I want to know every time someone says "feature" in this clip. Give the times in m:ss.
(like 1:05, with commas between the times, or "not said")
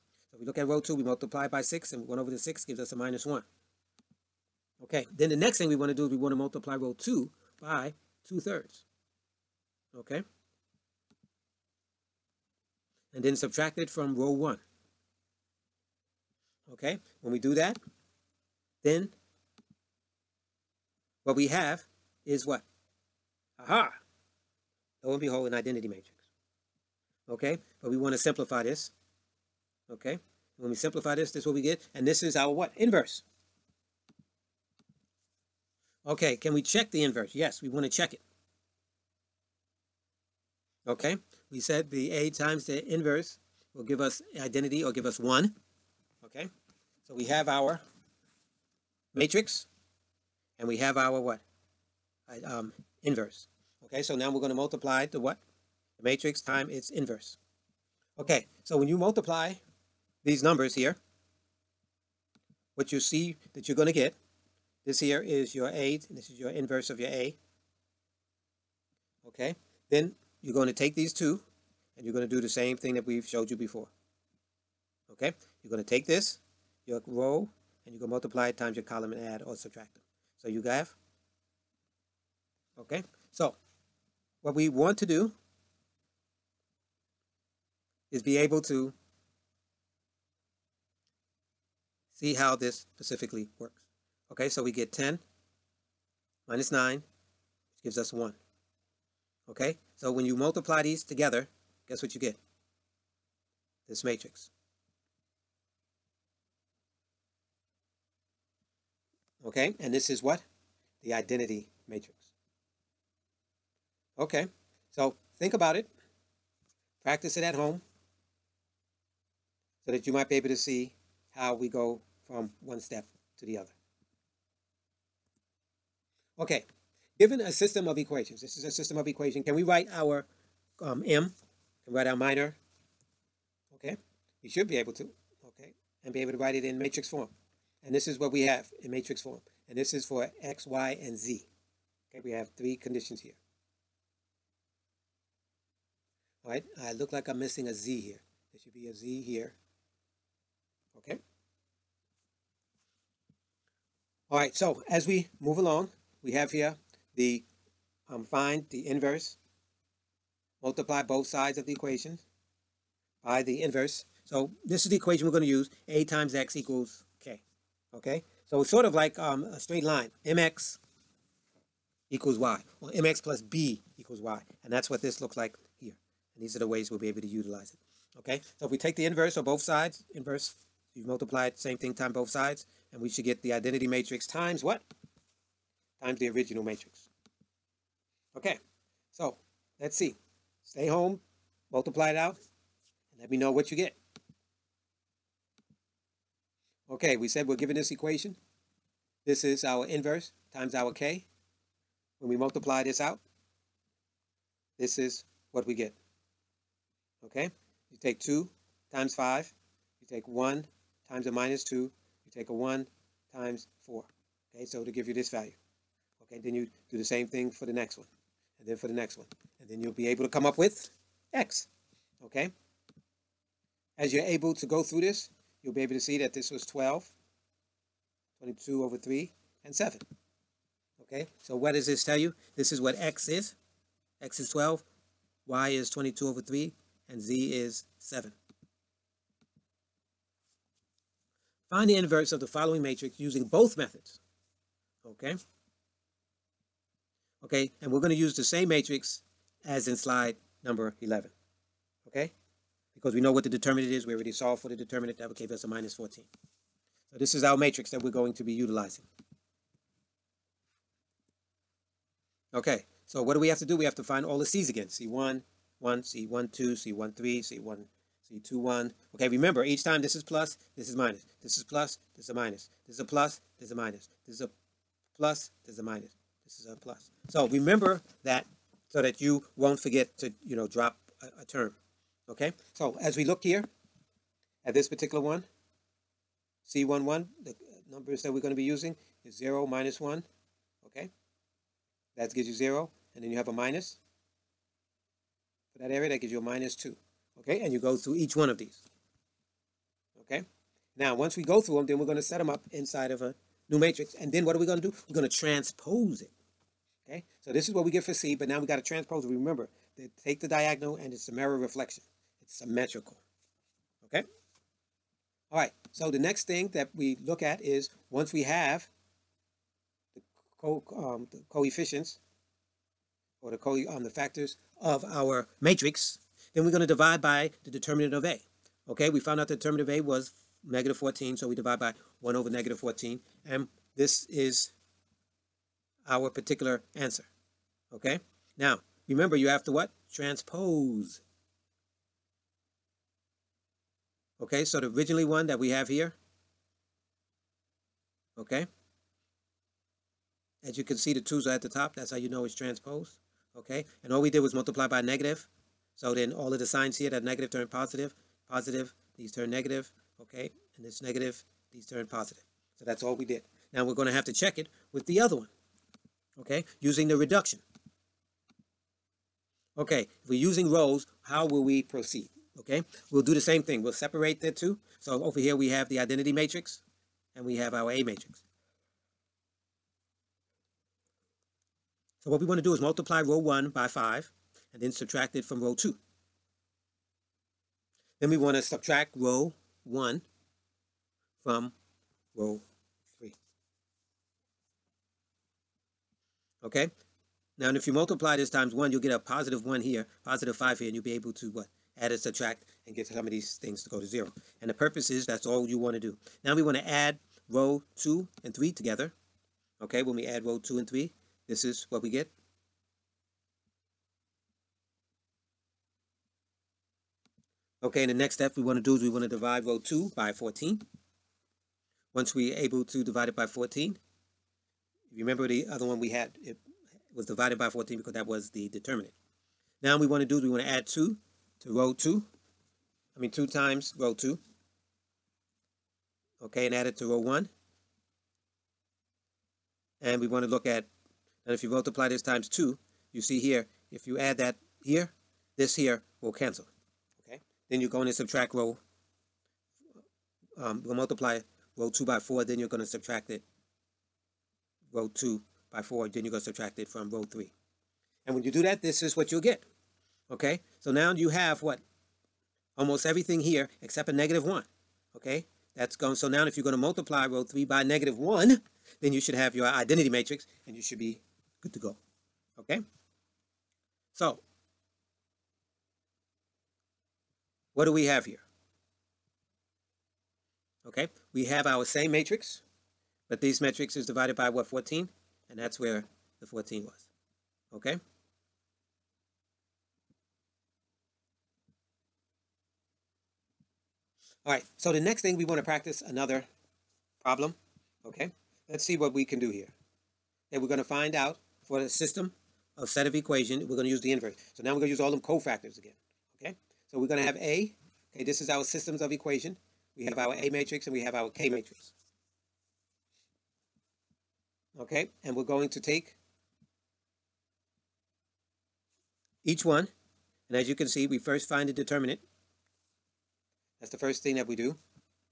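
not said.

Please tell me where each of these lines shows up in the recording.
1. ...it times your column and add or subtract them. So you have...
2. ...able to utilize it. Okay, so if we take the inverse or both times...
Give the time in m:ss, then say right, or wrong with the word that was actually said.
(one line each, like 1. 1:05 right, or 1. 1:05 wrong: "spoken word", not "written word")
1. 1:18 right
2. 2:57 wrong: "sides", not "times".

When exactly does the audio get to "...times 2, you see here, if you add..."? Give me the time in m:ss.
7:22.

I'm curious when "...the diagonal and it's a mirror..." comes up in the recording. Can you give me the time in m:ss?
5:10.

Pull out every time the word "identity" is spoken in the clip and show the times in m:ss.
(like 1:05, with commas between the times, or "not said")
0:25, 0:44, 1:51, 3:03, 6:15, 7:49.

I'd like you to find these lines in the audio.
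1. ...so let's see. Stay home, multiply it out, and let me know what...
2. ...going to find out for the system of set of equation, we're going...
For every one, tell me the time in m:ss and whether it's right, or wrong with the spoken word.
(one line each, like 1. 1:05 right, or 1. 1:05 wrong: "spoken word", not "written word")
1. 3:09 right
2. 8:20 right.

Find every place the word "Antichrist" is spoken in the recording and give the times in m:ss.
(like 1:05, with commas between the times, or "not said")
not said.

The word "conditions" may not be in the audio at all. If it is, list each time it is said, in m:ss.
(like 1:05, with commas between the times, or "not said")
2:22.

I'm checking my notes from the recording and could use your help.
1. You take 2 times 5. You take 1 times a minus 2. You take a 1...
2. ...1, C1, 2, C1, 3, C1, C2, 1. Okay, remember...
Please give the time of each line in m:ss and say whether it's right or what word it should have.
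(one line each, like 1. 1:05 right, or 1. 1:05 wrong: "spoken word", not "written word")
1. 3:27 right
2. 4:25 right.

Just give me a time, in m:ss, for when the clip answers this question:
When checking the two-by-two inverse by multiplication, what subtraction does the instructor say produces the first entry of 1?
1:34.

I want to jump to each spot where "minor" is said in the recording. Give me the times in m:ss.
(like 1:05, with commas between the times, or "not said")
2:12.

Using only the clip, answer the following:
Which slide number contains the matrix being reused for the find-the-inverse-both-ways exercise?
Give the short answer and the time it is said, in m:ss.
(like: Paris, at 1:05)
11, at 4:09.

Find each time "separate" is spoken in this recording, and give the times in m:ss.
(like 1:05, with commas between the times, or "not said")
6:13.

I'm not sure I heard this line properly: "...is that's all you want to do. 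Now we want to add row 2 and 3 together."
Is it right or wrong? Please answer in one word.
right.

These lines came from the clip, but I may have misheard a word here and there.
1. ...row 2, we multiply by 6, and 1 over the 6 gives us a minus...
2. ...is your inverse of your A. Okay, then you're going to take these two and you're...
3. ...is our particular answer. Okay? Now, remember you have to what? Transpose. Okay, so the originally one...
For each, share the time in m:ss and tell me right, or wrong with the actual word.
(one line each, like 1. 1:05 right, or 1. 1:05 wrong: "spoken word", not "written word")
1. 0:00 right
2. 1:06 right
3. 5:34 right.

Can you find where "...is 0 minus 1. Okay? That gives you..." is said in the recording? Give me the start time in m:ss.
4:49.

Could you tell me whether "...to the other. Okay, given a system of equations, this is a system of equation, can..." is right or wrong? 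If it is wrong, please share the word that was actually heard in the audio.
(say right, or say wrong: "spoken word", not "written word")
right.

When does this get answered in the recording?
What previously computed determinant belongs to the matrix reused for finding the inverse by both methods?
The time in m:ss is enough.
4:15.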